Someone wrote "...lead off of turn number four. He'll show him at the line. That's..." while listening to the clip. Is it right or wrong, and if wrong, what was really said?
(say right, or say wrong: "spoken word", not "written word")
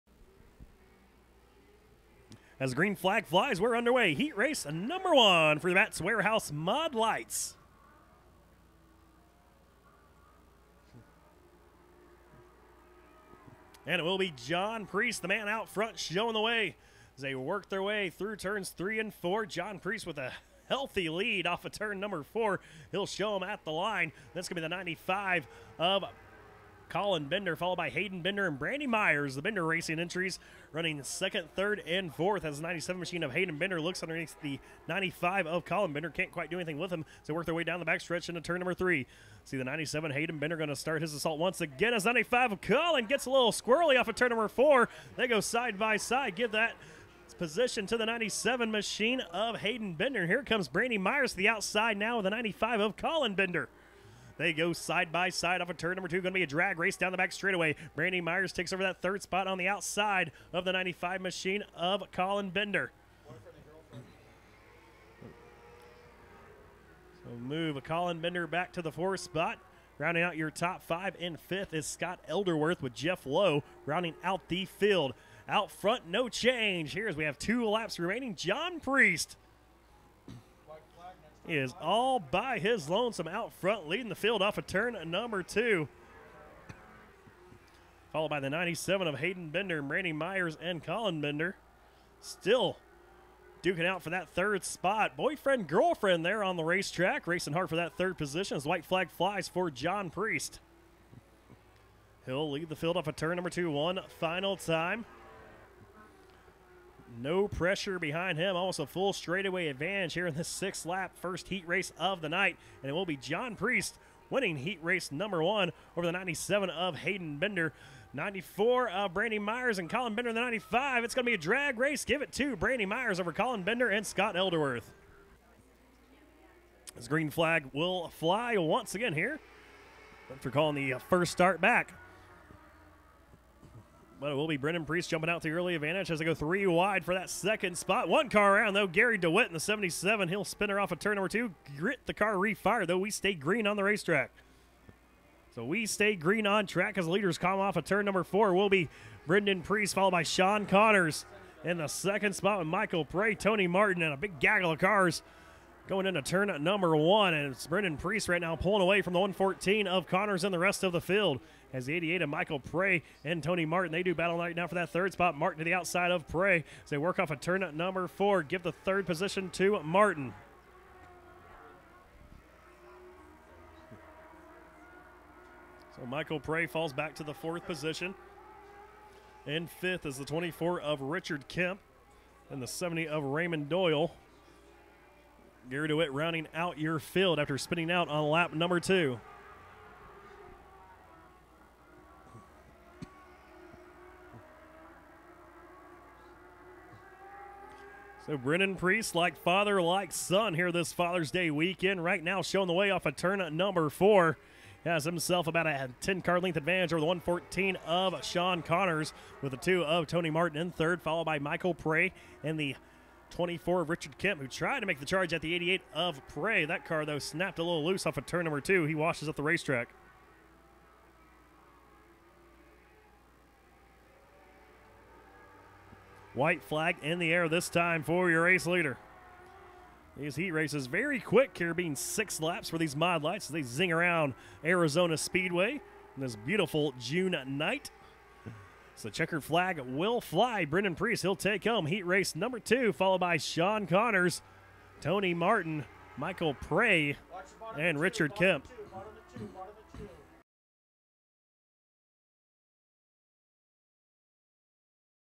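right.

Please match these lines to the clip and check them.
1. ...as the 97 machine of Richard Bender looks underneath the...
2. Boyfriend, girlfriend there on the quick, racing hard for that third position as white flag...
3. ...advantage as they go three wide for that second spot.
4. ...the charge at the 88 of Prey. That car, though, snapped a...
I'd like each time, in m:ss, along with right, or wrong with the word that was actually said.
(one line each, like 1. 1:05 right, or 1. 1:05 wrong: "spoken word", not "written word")
1. 0:32 wrong: "Hayden", not "Richard"
2. 1:35 wrong: "racetrack", not "quick"
3. 2:15 right
4. 3:34 right.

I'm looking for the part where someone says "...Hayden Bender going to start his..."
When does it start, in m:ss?
0:40.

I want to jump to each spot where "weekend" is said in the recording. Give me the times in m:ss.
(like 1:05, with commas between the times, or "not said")
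3:21.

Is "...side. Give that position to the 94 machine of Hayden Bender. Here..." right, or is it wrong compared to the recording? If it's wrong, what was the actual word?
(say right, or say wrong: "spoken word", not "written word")
wrong: "97", not "94".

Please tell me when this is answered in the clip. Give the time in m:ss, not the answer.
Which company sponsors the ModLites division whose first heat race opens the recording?
0:05.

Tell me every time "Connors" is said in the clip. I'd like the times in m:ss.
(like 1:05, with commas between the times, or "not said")
2:30, 2:40, 3:28, 4:03.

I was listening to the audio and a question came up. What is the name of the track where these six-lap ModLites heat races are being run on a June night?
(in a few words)
Arizona Speedway.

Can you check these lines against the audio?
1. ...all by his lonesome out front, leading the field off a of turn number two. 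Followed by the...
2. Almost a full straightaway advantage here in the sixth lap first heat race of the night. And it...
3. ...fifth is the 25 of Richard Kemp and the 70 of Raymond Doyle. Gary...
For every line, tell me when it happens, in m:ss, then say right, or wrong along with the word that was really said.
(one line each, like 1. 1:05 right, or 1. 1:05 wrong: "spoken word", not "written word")
1. 1:21 right
2. 1:48 right
3. 2:59 wrong: "24", not "25".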